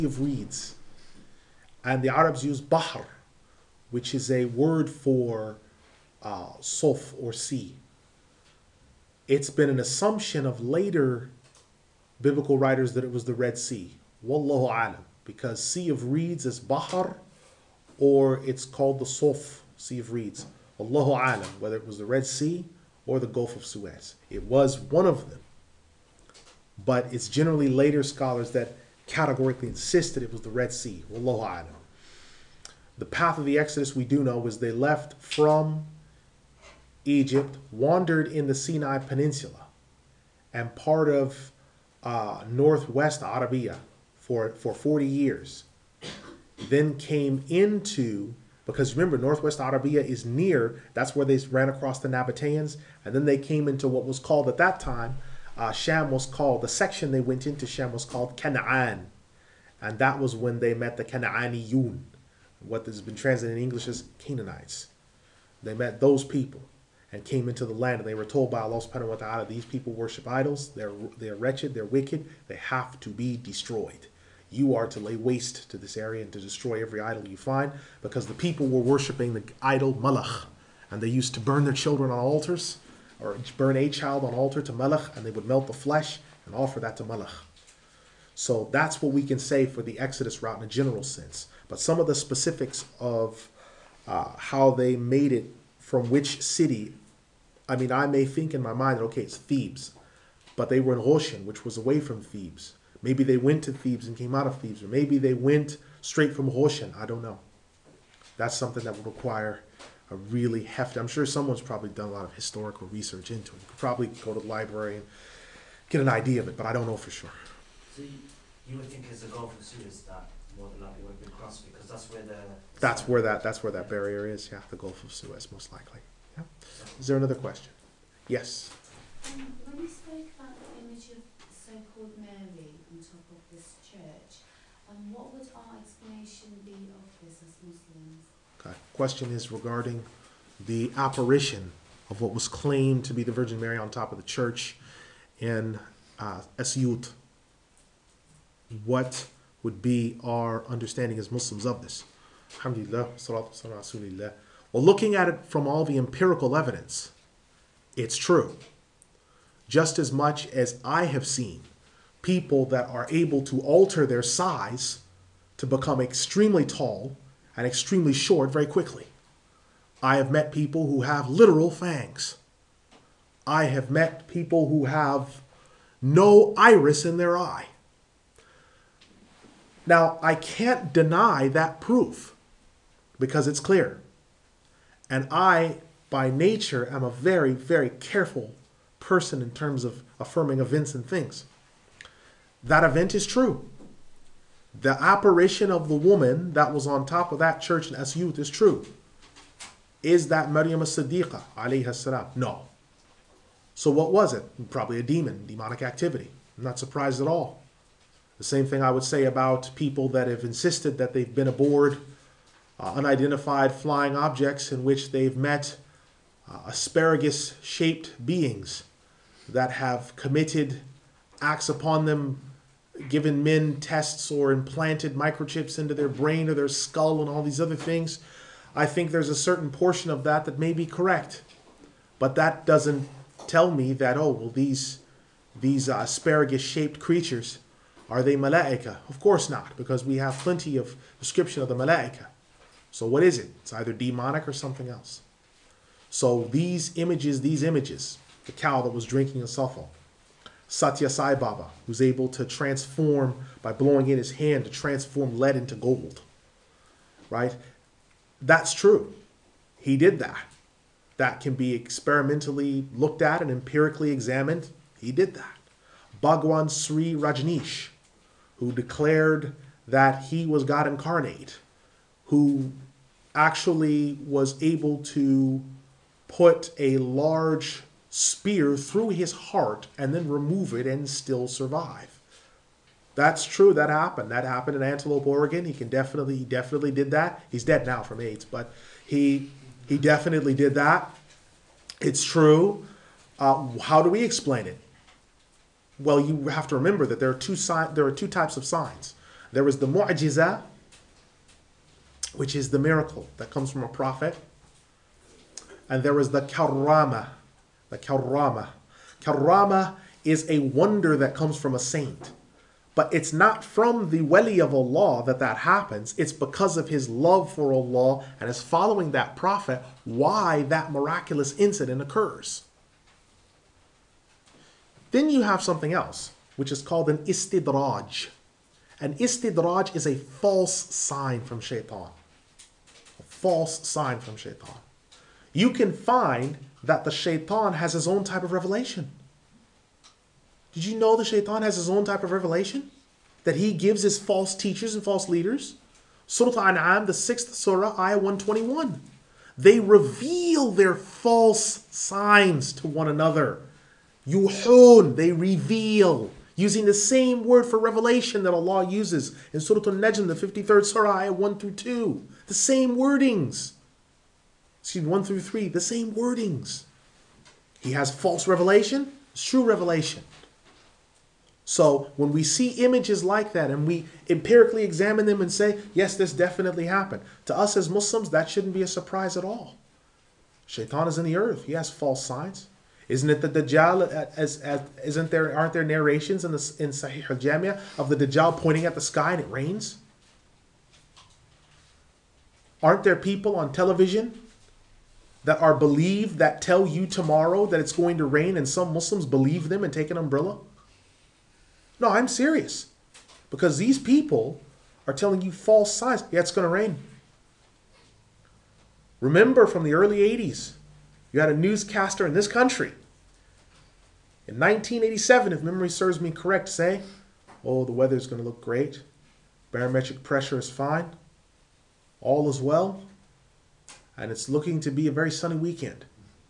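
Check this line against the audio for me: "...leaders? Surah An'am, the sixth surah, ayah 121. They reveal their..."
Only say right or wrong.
right.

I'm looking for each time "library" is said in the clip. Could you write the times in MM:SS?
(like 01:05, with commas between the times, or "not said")
01:54.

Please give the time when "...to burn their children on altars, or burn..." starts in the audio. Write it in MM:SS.
01:21.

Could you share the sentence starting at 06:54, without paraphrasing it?
In 1987, if memory serves me correct, say, oh, the weather is going to look great.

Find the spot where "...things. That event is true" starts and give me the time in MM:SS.
03:11.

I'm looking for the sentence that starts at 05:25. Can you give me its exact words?
Then you have something else, which is called an istidraj.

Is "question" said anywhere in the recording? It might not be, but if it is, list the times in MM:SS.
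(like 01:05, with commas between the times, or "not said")
02:07, 02:18.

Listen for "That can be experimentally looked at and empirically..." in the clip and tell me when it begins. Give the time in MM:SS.
04:21.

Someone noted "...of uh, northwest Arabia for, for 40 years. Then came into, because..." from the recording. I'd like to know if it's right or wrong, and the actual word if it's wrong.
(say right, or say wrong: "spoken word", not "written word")
right.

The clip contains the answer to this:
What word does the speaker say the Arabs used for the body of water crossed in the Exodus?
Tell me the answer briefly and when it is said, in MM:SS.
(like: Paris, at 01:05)
bahr, at 00:02.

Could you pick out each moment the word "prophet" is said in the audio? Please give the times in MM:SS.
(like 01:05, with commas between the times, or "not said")
05:03, 05:19.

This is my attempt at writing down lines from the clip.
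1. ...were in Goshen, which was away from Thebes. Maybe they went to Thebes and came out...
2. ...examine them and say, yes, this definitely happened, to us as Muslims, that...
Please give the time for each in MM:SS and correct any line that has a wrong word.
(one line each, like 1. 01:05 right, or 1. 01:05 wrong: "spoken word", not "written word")
1. 01:40 right
2. 06:14 right.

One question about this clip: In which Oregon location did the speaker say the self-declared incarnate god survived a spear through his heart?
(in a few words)
Antelope, Oregon.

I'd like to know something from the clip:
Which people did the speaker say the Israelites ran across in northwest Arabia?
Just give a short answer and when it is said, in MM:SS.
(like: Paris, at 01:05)
Nabateans, at 00:52.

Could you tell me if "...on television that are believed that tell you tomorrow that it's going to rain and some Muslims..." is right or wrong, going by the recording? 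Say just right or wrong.
right.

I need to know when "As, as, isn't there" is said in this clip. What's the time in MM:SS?
06:24.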